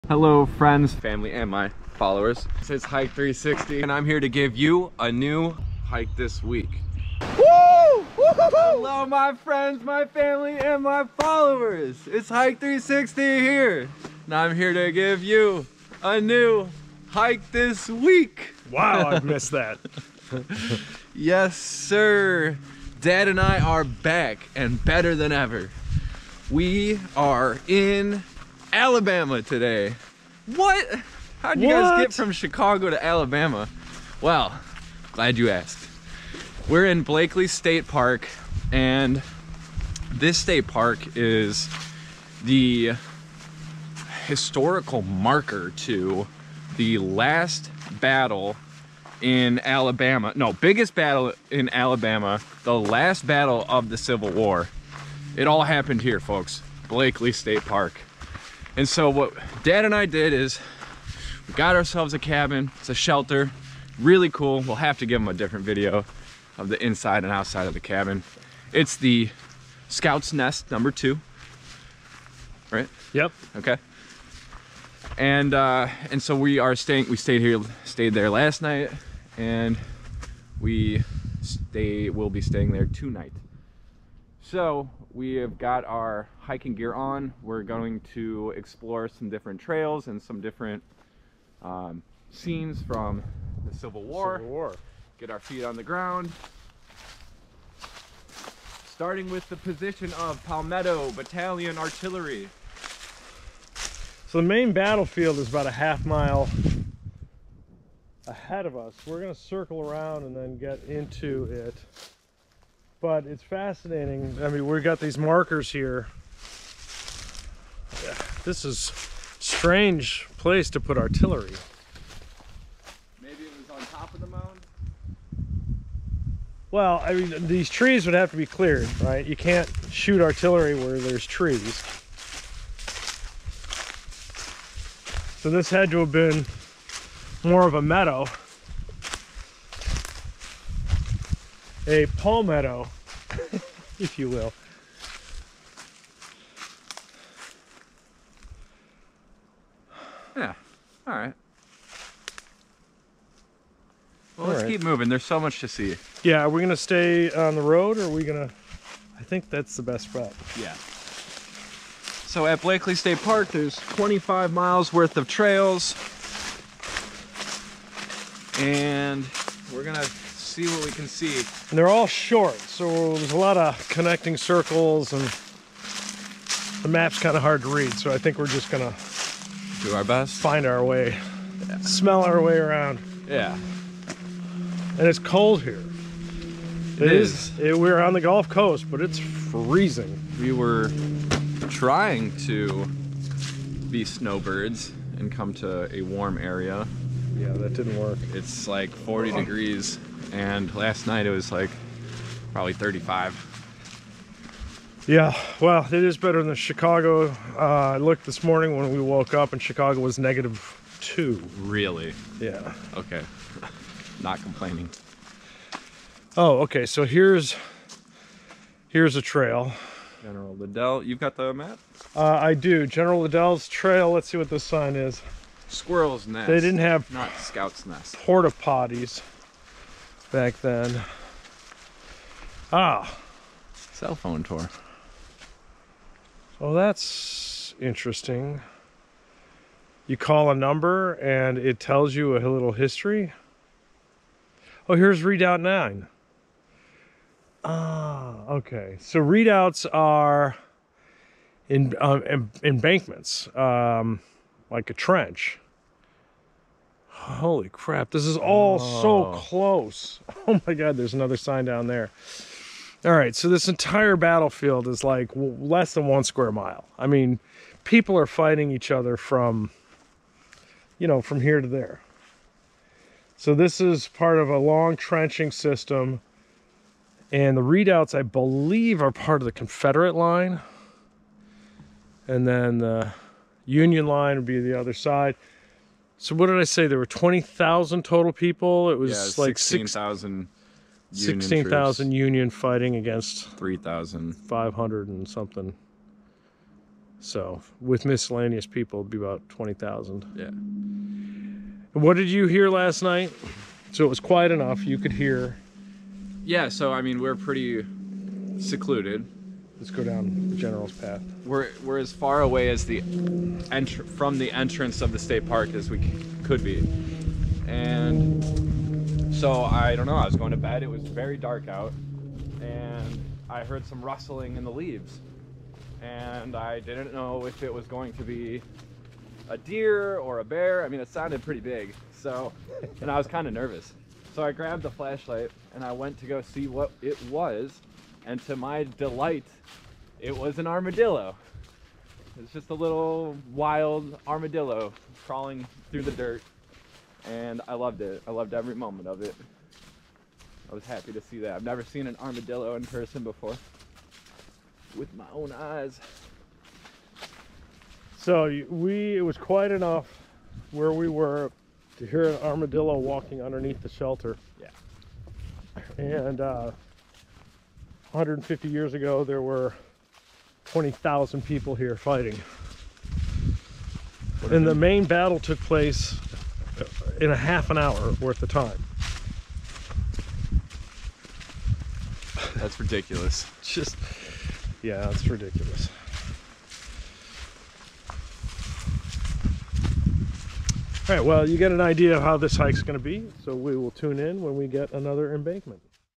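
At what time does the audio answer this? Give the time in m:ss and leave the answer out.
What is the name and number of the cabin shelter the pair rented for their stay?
1:09.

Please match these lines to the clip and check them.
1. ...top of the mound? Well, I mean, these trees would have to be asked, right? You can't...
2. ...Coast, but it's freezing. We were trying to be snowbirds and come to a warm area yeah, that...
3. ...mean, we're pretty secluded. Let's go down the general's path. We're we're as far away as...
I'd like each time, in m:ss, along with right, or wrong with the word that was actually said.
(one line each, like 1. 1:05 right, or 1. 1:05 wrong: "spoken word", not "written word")
1. 2:03 wrong: "cleared", not "asked"
2. 3:08 right
3. 5:07 right.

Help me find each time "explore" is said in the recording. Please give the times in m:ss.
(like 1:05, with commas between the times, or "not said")
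1:28.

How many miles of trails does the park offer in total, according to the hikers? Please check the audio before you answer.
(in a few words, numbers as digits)
25 miles.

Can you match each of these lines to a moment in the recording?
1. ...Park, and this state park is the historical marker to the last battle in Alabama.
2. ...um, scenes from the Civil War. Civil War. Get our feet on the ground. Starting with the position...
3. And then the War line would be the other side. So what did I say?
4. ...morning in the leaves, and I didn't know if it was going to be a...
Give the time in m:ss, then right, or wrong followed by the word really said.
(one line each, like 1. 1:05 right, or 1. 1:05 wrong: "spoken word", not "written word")
1. 0:37 right
2. 1:31 right
3. 4:42 wrong: "Union", not "War"
4. 5:24 wrong: "rustling", not "morning".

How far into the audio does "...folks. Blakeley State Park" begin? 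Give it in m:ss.
0:56.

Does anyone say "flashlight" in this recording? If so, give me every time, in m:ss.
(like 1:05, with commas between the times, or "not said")
5:34.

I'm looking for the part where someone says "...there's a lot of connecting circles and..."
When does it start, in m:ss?
2:53.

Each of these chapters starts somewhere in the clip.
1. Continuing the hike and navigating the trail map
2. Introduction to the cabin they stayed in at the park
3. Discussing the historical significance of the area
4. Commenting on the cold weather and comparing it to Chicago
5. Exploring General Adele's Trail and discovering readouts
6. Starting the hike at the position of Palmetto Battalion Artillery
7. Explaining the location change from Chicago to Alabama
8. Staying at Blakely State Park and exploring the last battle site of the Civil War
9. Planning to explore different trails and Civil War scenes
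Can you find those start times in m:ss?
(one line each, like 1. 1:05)
1. 2:34
2. 1:01
3. 2:06
4. 3:01
5. 3:34
6. 1:34
7. 0:22
8. 0:34
9. 1:17.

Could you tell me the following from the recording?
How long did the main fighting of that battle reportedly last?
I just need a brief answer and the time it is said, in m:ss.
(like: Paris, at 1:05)
half an hour, at 6:17.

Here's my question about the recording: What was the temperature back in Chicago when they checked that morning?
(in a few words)
-2.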